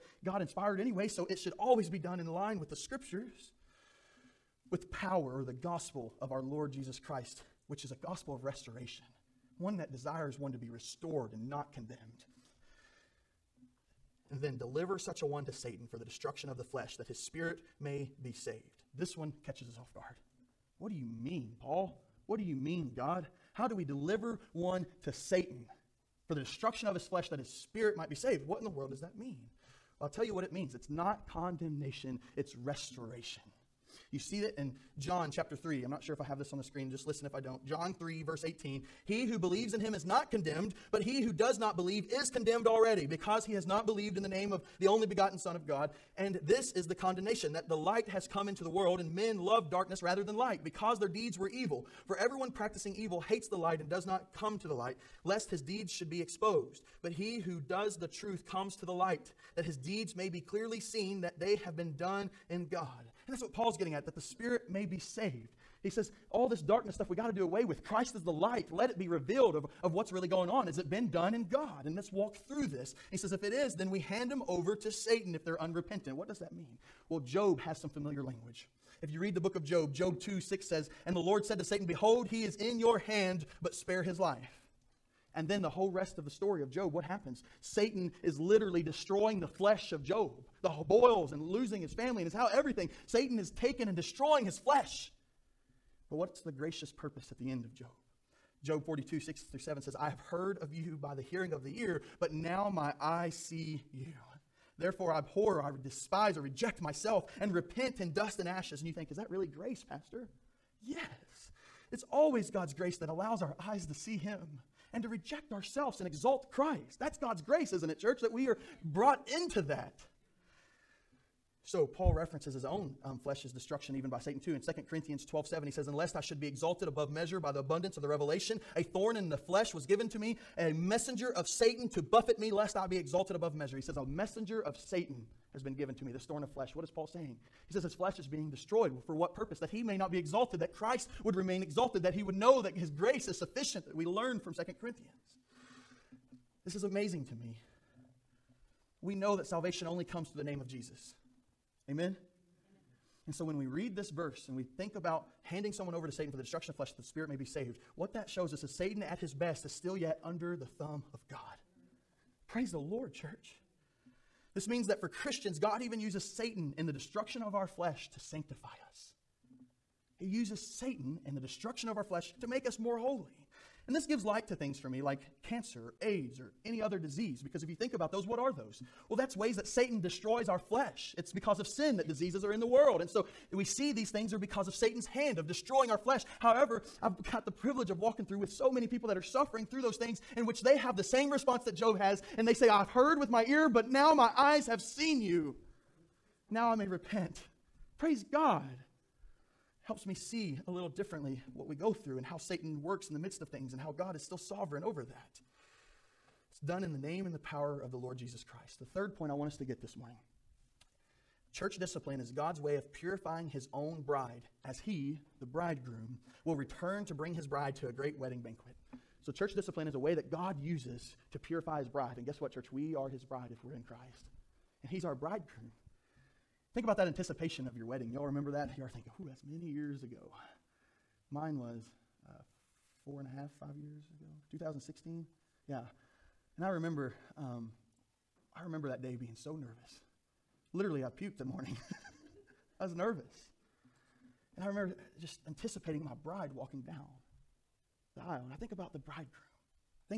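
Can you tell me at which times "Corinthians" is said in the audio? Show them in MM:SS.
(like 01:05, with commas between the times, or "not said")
02:04, 02:24.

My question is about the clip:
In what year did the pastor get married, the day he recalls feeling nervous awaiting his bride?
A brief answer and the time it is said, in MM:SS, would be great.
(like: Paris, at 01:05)
2016, at 03:54.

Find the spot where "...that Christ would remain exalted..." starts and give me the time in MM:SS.
02:20.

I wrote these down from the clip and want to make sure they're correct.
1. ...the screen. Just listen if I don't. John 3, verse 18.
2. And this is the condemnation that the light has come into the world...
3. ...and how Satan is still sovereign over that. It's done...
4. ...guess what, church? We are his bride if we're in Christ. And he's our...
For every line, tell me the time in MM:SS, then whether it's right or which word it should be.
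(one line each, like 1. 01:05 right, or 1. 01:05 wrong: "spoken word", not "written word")
1. 00:36 right
2. 00:46 right
3. 03:23 wrong: "God", not "Satan"
4. 03:42 right.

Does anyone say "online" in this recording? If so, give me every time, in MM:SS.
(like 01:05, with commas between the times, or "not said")
not said.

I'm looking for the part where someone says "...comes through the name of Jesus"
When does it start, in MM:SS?
02:30.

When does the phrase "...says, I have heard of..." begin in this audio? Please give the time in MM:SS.
01:39.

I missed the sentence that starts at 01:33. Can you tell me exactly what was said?
Satan is taken and destroying his flesh.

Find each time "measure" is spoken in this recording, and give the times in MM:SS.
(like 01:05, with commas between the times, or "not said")
02:07, 02:13.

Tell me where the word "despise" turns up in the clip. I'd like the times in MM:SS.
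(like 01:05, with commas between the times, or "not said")
01:45.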